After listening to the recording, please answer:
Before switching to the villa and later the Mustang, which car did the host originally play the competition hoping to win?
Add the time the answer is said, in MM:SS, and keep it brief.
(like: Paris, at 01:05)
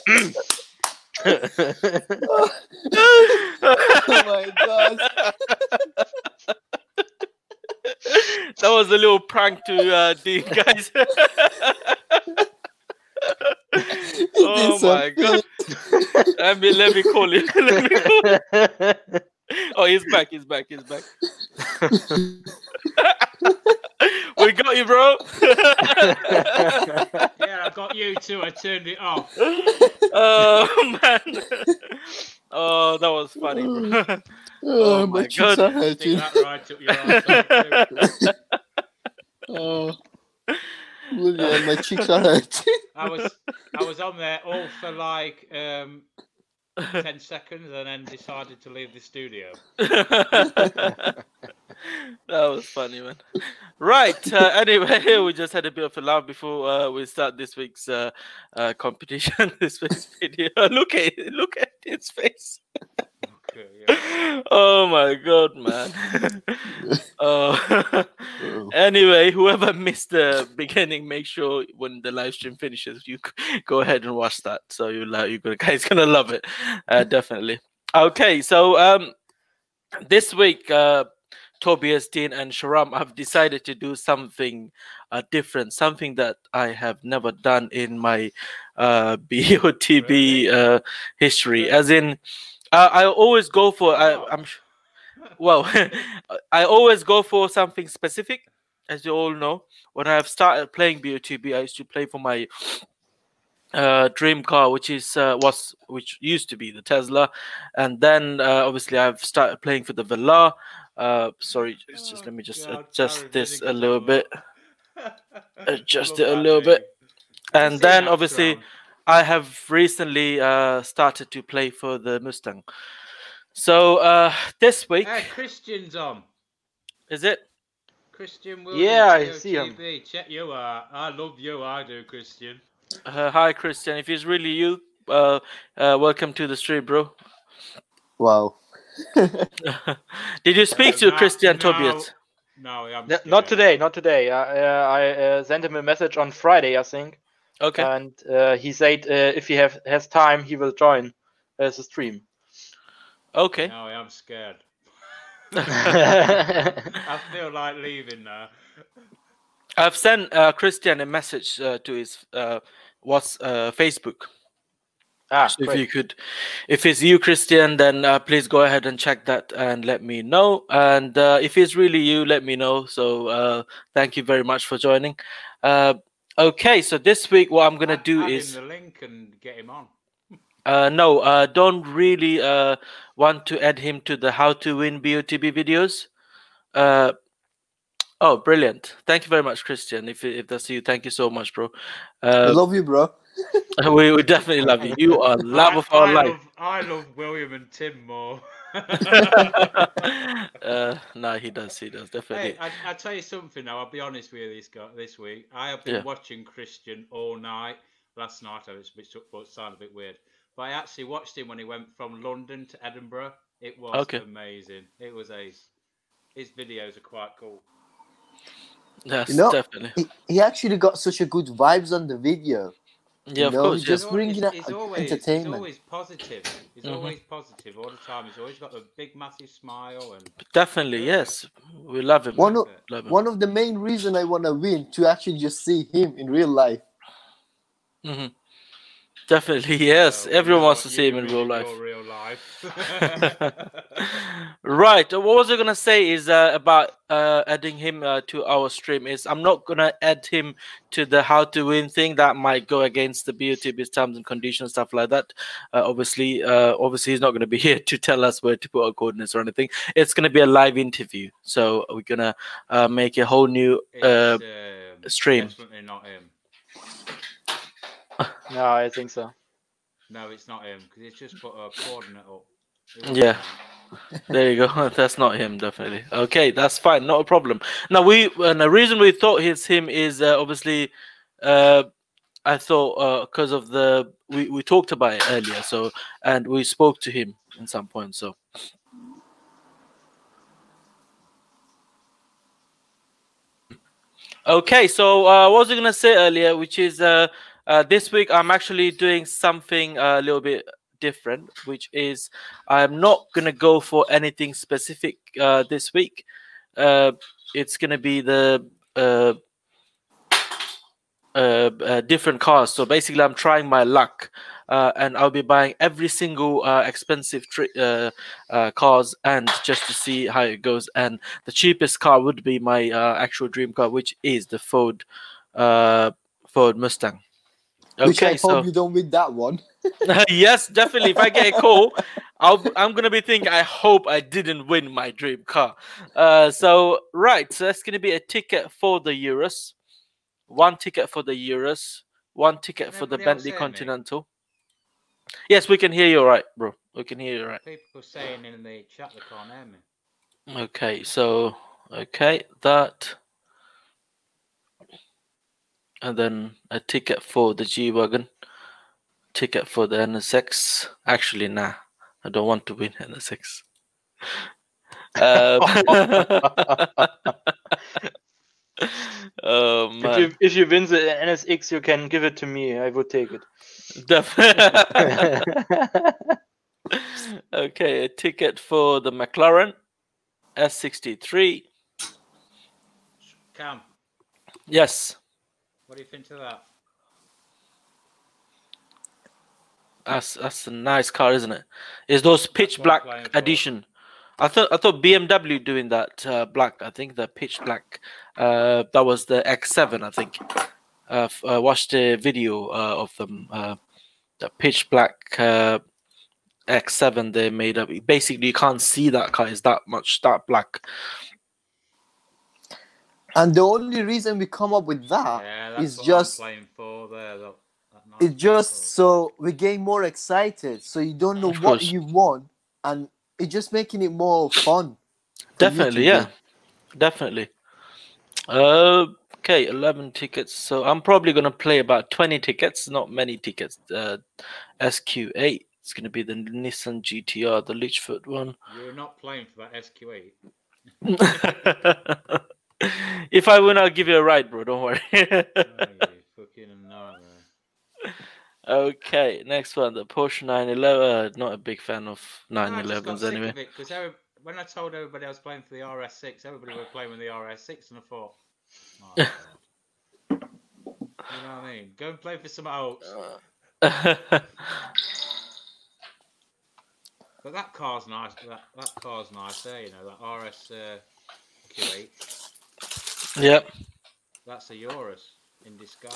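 Tesla, at 01:46.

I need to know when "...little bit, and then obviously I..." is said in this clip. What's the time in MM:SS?
01:56.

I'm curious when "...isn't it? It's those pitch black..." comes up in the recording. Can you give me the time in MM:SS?
06:31.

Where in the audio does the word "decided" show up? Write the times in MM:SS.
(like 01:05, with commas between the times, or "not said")
00:48, 01:23.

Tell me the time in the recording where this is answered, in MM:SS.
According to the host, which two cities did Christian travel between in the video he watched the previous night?
03:32.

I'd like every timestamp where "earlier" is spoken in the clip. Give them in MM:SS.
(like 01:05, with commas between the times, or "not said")
04:45, 04:56.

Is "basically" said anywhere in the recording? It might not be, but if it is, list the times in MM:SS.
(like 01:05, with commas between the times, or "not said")
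05:12, 06:48.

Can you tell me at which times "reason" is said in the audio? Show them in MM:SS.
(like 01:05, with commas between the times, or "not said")
03:53, 04:38, 06:54.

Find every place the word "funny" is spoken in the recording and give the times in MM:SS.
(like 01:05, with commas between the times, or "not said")
00:33, 00:52.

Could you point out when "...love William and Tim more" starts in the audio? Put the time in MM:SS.
03:16.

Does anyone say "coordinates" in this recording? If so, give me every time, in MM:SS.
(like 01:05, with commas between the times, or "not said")
04:18, 04:31.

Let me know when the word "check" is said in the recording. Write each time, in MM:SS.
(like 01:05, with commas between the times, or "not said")
02:10, 02:48.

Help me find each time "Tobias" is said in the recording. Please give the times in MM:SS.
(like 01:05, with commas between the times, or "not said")
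01:21, 02:21.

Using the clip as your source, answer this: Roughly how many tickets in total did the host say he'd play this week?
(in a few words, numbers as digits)
20.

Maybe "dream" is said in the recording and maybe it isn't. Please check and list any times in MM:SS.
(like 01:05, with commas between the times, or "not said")
01:44, 05:23, 05:35.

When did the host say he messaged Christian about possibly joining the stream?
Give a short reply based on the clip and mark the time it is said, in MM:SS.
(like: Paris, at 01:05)
Friday, at 02:26.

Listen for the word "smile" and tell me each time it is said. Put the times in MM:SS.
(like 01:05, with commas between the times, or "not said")
03:49.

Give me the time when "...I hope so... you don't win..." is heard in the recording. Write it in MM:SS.
05:28.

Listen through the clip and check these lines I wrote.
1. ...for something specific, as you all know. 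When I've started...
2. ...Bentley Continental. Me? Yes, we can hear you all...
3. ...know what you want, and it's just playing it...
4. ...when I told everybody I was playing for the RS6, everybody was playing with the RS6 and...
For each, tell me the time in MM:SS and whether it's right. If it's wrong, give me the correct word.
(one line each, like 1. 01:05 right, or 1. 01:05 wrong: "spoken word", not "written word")
1. 01:37 right
2. 05:43 right
3. 07:01 wrong: "making", not "playing"
4. 07:34 right.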